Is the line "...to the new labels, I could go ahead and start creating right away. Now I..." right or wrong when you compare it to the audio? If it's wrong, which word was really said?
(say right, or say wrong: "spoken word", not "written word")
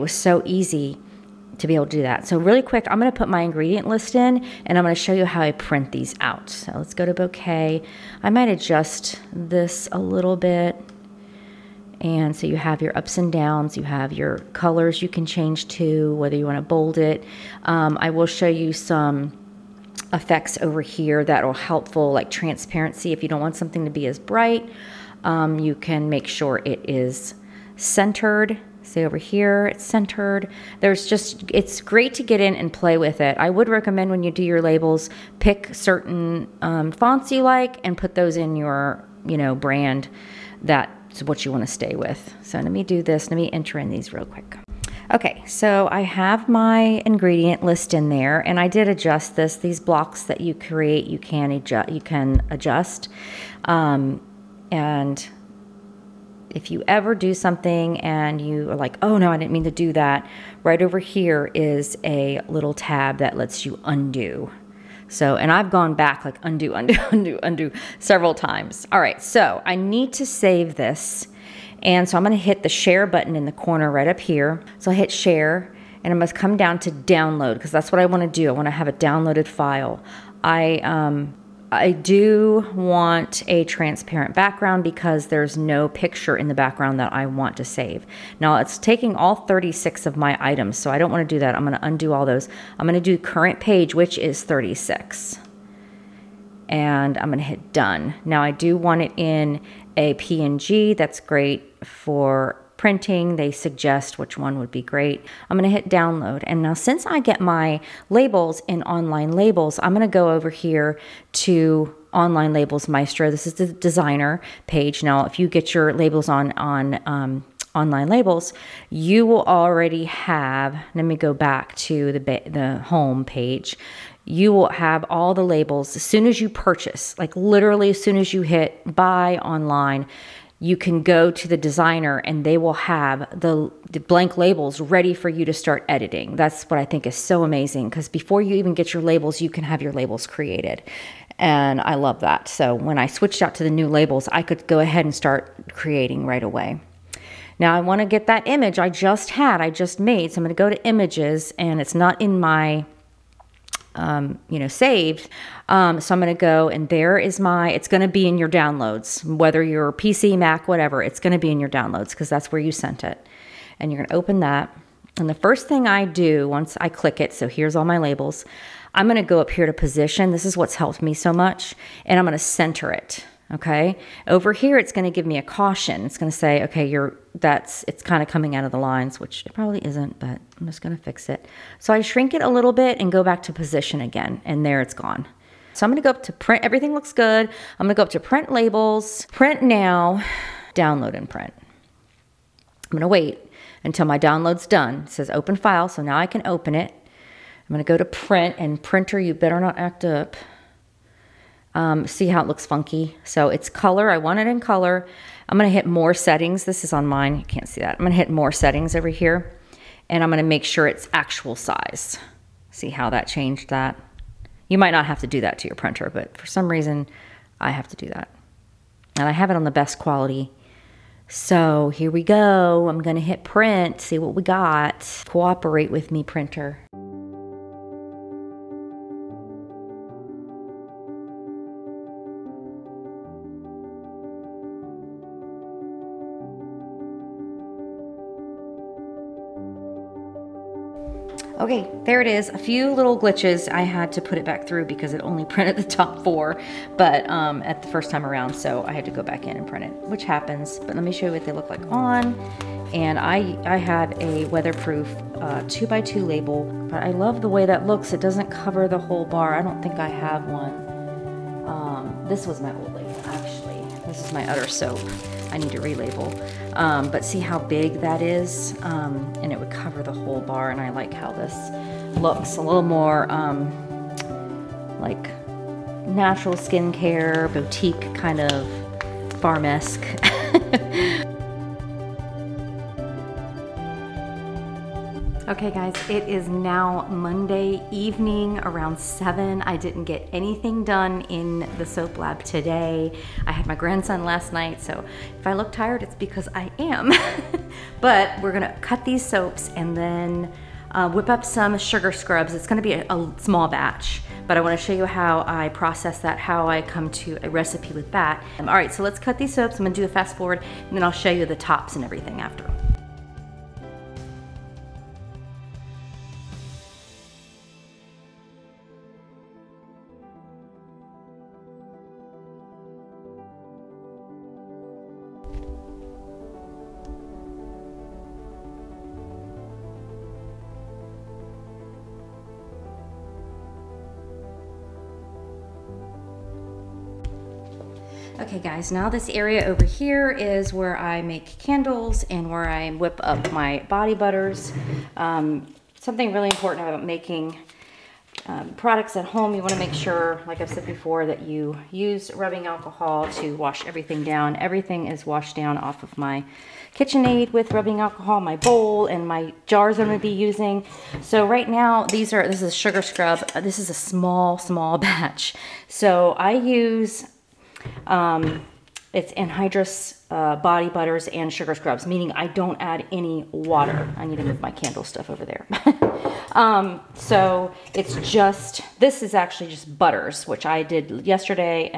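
right.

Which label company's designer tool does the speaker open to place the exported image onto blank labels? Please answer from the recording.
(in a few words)
Online Labels Maestro.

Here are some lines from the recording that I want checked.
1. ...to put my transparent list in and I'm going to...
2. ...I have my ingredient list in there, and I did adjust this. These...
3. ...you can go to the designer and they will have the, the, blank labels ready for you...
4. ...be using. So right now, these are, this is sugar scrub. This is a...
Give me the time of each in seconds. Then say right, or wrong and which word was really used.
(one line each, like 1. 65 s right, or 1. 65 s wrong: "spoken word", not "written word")
1. 3 s wrong: "ingredient", not "transparent"
2. 45 s right
3. 130 s right
4. 360 s right.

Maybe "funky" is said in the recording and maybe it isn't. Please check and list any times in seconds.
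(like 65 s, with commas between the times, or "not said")
202 s.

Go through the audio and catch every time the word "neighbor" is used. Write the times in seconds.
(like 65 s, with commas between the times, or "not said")
not said.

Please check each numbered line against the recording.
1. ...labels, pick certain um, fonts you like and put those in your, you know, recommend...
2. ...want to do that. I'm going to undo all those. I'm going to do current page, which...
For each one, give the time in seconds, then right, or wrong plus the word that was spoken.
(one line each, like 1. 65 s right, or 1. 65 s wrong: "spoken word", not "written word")
1. 34 s wrong: "brand", not "recommend"
2. 91 s right.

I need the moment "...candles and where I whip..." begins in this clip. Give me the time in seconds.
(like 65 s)
341 s.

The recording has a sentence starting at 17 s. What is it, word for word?
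Um, I will show you some effects over here that are helpful, like transparency.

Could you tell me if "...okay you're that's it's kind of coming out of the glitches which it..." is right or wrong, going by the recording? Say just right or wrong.
wrong.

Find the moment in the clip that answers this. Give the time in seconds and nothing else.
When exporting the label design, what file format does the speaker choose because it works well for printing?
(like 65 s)
100 s.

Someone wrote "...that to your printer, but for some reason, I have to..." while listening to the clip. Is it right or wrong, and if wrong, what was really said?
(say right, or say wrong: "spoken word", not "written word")
right.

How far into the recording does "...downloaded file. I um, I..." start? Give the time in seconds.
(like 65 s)
78 s.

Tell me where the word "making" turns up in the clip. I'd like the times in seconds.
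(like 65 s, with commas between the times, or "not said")
347 s.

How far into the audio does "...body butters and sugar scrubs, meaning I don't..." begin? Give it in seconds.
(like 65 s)
370 s.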